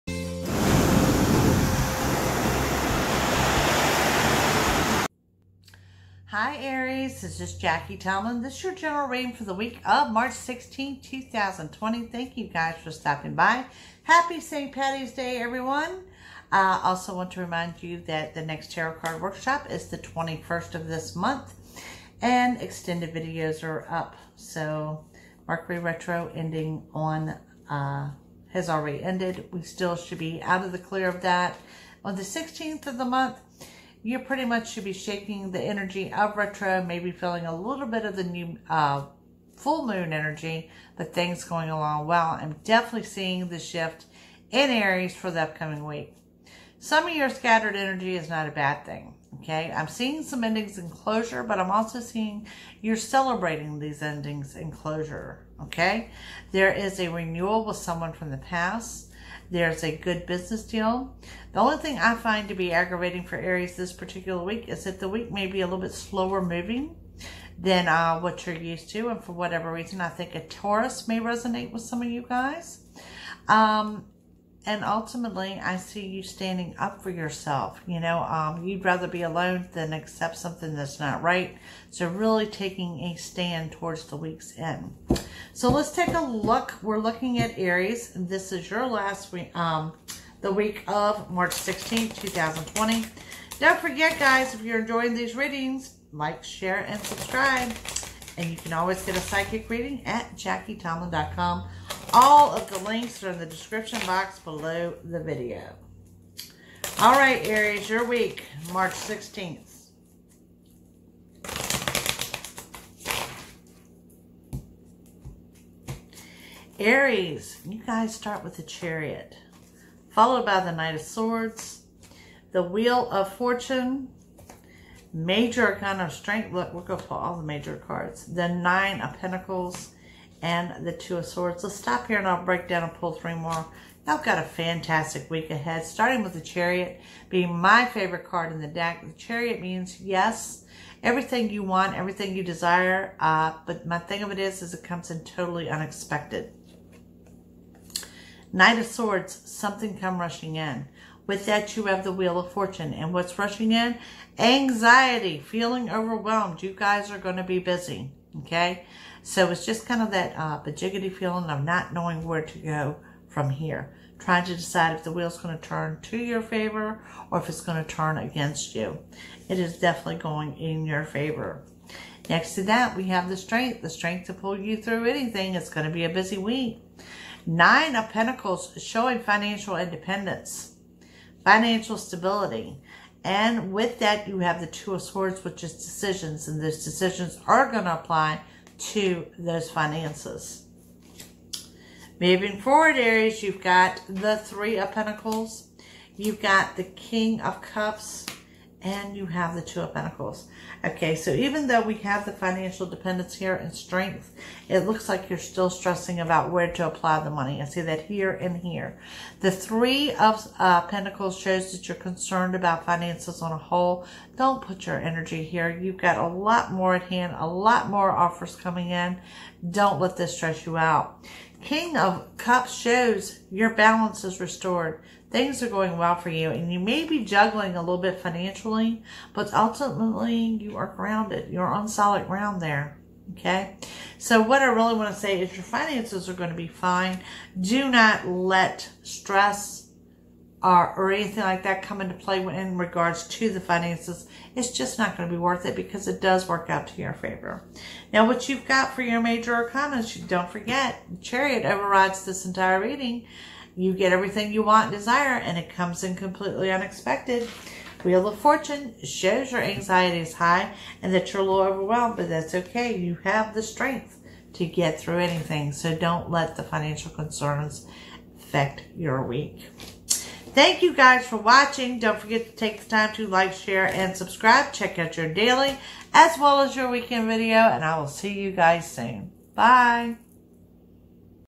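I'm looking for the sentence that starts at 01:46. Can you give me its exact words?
All right, Aries, your week, March 16th.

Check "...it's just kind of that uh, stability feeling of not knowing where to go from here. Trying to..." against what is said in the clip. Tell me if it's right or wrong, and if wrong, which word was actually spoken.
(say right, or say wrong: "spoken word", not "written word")
wrong: "bajiggity", not "stability".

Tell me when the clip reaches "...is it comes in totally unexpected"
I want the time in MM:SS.
02:24.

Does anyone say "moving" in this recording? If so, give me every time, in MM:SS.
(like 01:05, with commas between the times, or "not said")
01:06, 03:12.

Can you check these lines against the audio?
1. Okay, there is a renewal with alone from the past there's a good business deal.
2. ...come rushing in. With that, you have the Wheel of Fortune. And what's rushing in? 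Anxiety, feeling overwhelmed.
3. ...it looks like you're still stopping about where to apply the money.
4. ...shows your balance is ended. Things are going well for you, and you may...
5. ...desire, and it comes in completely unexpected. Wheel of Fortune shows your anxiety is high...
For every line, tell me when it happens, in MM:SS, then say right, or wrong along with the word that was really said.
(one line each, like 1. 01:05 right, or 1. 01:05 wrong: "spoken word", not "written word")
1. 00:55 wrong: "someone", not "alone"
2. 02:29 right
3. 03:24 wrong: "stressing", not "stopping"
4. 03:42 wrong: "restored", not "ended"
5. 04:14 right.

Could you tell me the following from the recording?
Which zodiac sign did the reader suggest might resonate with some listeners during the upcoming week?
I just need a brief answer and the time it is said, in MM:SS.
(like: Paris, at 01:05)
Taurus, at 01:10.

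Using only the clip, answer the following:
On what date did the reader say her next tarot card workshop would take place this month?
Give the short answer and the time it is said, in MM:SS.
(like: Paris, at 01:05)
21st, at 00:19.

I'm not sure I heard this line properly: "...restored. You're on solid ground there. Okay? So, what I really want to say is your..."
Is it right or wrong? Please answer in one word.
wrong.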